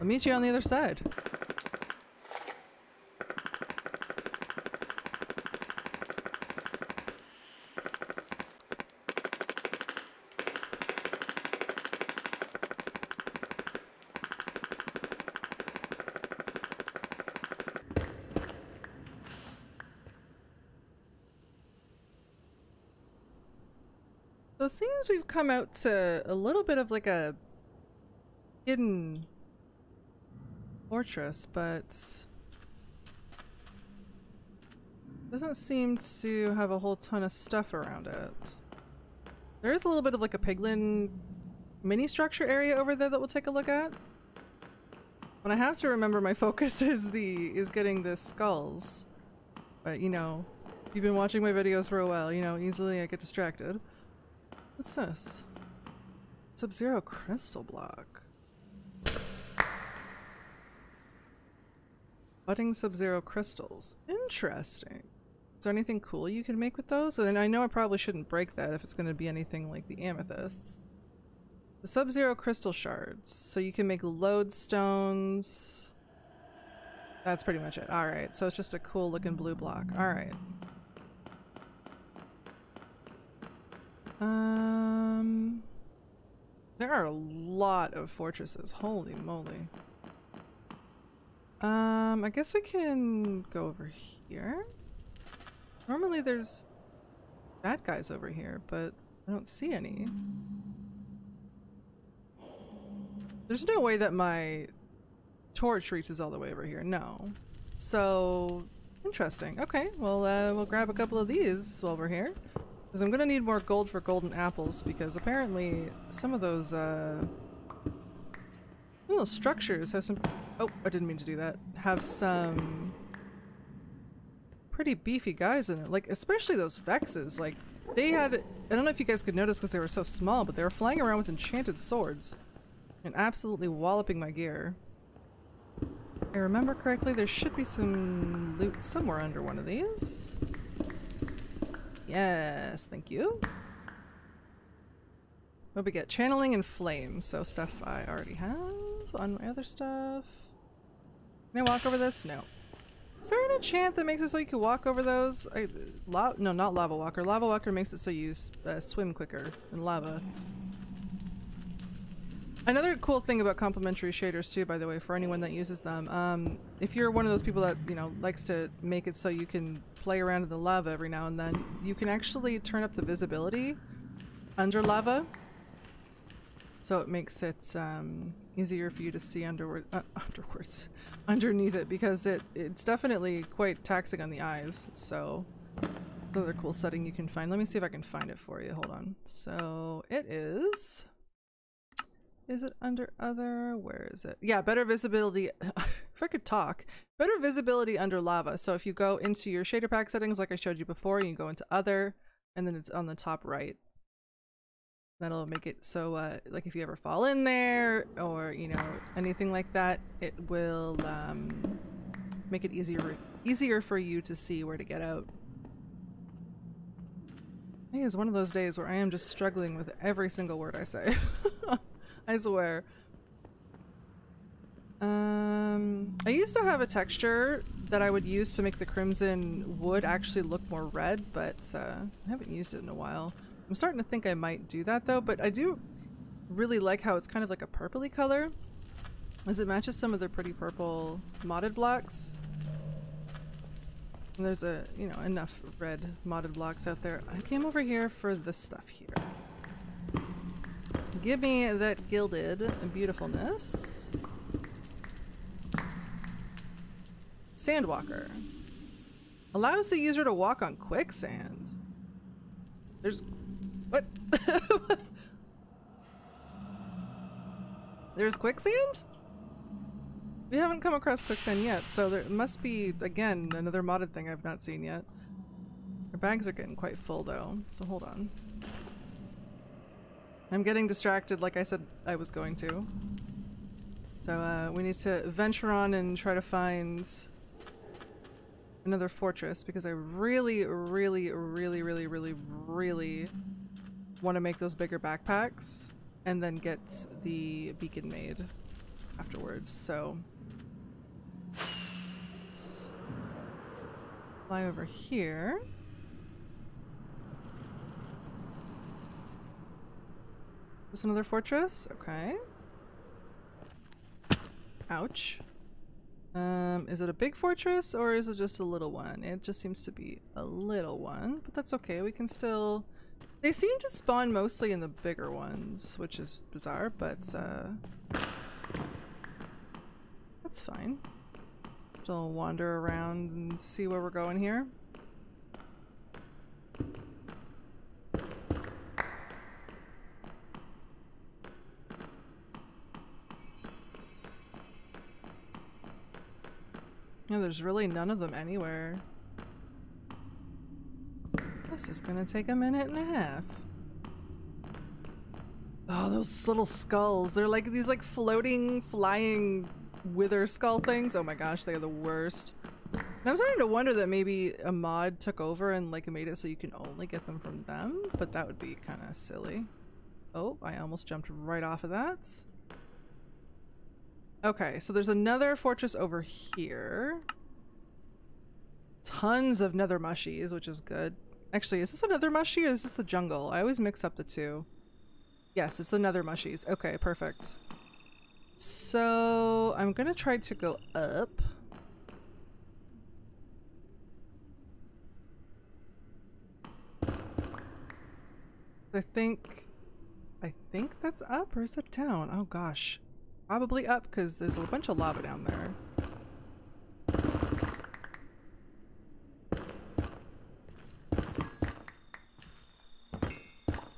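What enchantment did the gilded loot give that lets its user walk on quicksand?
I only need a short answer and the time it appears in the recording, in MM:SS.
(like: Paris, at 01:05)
Sandwalker, at 04:17.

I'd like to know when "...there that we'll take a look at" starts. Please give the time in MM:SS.
00:42.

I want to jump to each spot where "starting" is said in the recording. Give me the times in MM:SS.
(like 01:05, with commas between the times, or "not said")
03:53, 06:03.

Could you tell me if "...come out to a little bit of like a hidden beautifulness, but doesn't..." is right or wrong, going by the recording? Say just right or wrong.
wrong.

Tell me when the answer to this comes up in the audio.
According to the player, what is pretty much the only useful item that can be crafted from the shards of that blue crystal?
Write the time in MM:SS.
01:14.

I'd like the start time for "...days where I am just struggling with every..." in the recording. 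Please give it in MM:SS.
03:38.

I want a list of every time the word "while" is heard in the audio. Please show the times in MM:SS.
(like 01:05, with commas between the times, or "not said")
00:52, 01:51, 03:52.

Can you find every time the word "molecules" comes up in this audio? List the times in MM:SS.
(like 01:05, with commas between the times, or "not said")
not said.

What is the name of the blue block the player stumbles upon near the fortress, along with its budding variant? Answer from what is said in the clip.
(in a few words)
Sub-Zero Crystal Block.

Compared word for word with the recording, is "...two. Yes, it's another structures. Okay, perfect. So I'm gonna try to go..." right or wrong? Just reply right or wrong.
wrong.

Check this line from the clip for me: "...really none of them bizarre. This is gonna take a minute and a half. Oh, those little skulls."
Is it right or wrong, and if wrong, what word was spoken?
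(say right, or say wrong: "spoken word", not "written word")
wrong: "anywhere", not "bizarre".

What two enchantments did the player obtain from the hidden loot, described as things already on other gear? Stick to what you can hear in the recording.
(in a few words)
Channeling and flame.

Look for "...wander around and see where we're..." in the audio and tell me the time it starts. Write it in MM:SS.
05:32.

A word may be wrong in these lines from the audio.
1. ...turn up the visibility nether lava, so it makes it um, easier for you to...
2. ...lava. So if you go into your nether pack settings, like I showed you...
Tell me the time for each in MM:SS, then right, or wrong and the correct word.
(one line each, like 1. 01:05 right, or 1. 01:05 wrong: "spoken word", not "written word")
1. 02:52 wrong: "under", not "nether"
2. 03:18 wrong: "shader", not "nether".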